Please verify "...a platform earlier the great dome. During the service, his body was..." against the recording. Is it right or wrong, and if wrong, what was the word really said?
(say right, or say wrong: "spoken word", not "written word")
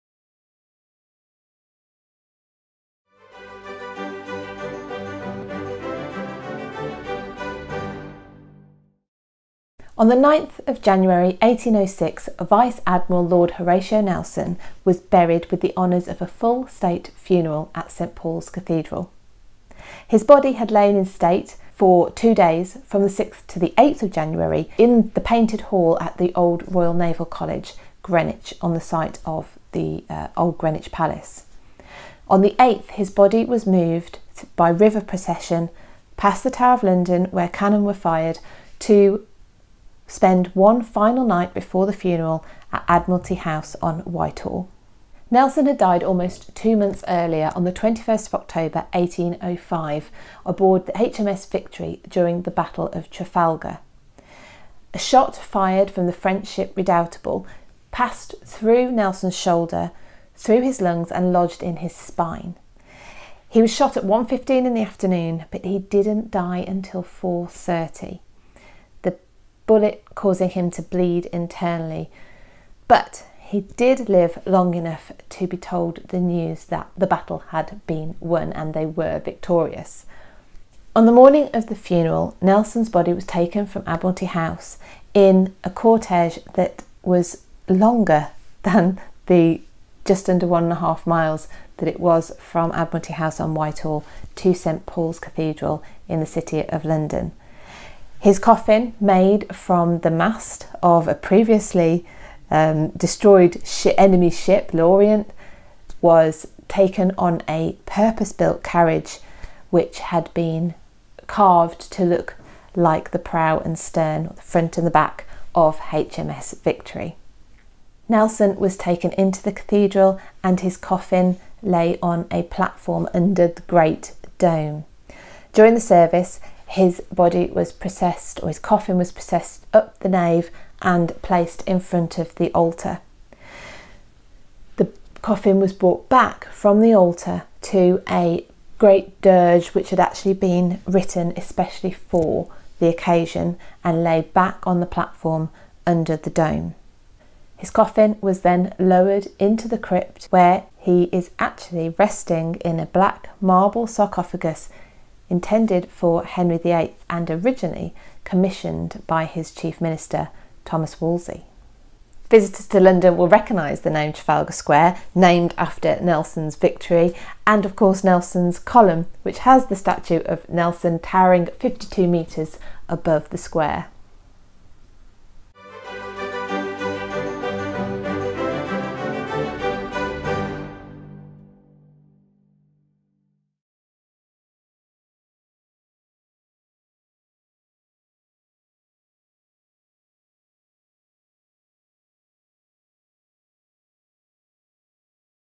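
wrong: "under", not "earlier".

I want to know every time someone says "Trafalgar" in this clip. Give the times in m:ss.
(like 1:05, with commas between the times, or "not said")
0:53, 2:44.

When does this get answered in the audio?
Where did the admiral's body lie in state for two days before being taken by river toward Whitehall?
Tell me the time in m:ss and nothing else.
0:25.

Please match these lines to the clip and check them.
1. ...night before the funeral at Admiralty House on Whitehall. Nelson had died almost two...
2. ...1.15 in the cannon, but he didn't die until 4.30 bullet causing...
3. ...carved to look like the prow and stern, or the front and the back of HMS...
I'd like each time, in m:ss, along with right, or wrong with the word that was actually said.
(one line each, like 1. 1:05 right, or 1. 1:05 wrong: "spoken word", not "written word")
1. 0:41 right
2. 1:04 wrong: "afternoon", not "cannon"
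3. 1:51 right.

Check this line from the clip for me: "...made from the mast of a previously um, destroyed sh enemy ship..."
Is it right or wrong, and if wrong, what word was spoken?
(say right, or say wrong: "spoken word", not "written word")
right.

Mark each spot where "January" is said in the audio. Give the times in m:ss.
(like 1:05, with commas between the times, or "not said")
0:10, 0:24.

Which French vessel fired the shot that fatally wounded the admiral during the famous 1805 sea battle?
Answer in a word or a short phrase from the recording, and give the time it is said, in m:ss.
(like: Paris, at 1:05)
Redoubtable, at 0:56.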